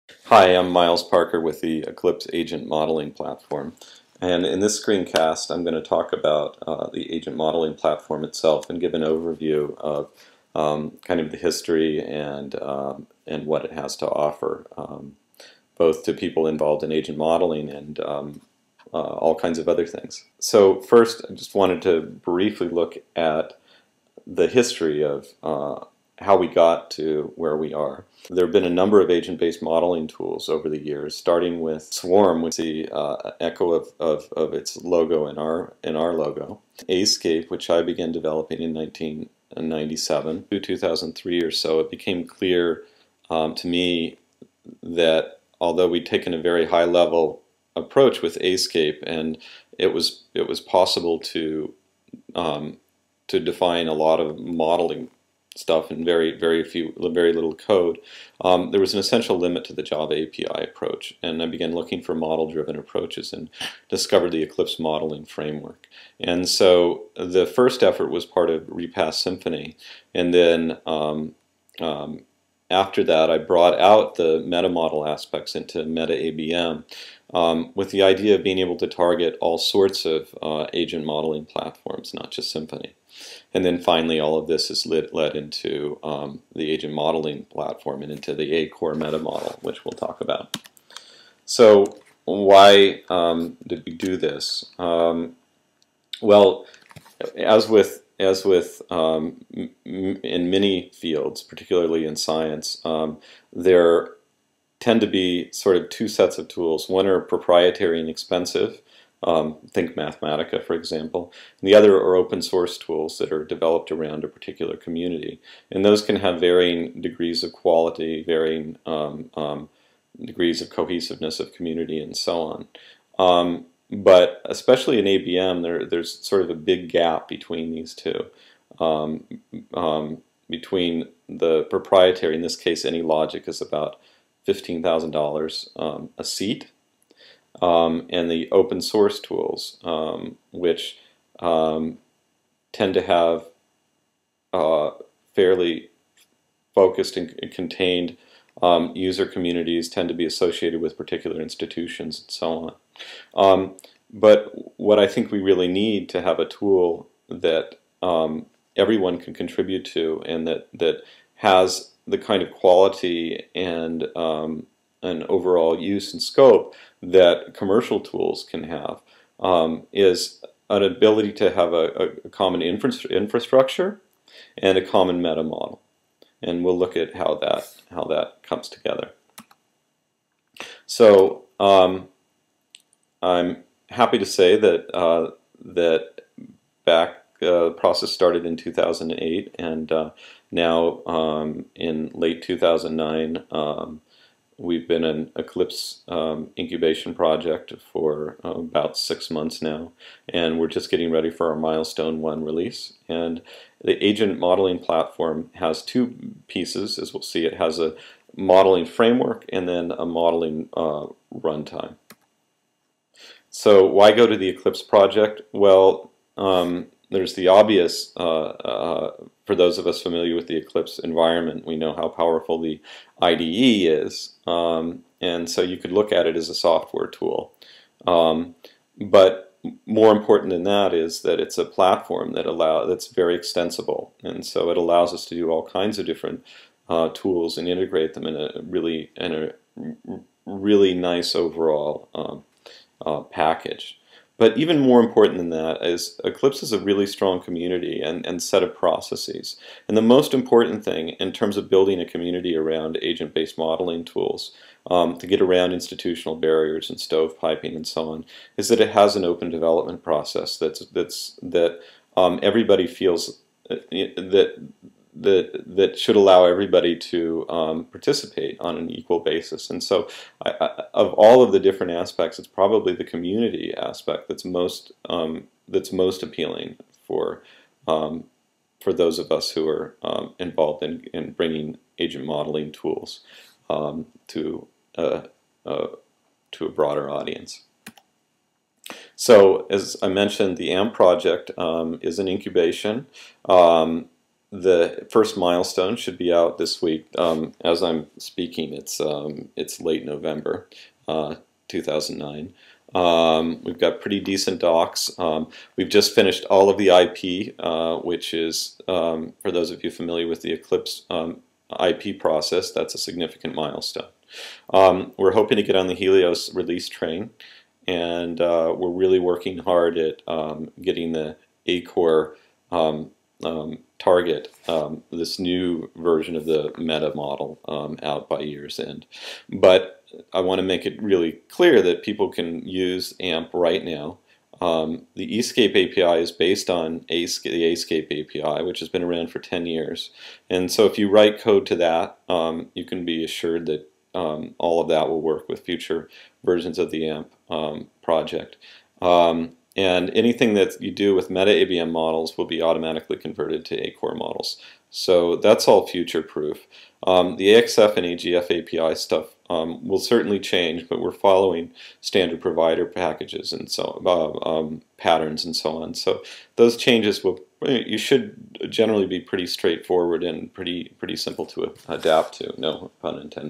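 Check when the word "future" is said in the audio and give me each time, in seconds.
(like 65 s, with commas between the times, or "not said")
345 s, 355 s.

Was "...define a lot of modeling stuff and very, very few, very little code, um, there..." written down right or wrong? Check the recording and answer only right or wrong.
right.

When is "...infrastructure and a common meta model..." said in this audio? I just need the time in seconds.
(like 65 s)
173 s.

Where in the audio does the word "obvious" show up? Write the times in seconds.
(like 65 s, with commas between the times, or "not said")
217 s.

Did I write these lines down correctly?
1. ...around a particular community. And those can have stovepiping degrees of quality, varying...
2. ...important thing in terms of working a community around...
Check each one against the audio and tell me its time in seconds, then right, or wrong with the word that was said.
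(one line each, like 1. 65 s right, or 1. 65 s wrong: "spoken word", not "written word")
1. 113 s wrong: "varying", not "stovepiping"
2. 250 s wrong: "building", not "working".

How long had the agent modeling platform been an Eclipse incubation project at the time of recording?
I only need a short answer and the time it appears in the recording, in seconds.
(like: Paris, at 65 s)
about six months, at 198 s.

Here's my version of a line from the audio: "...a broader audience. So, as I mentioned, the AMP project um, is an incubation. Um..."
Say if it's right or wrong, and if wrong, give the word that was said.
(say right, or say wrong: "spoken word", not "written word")
right.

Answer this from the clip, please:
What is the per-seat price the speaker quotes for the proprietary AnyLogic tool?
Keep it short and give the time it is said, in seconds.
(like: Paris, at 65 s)
$15,000, at 134 s.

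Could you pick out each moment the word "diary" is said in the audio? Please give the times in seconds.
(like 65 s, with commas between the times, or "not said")
not said.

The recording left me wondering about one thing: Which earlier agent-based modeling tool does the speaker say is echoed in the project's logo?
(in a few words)
Swarm.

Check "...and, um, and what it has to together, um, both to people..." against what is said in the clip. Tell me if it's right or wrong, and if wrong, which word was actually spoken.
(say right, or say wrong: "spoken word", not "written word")
wrong: "offer", not "together".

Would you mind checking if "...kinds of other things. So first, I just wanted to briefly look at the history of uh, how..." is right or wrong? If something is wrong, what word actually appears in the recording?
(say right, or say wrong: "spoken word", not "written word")
right.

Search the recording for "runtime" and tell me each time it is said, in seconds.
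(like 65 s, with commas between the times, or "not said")
211 s.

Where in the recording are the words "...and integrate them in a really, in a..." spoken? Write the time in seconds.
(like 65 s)
237 s.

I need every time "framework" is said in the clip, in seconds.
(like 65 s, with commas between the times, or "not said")
65 s, 208 s.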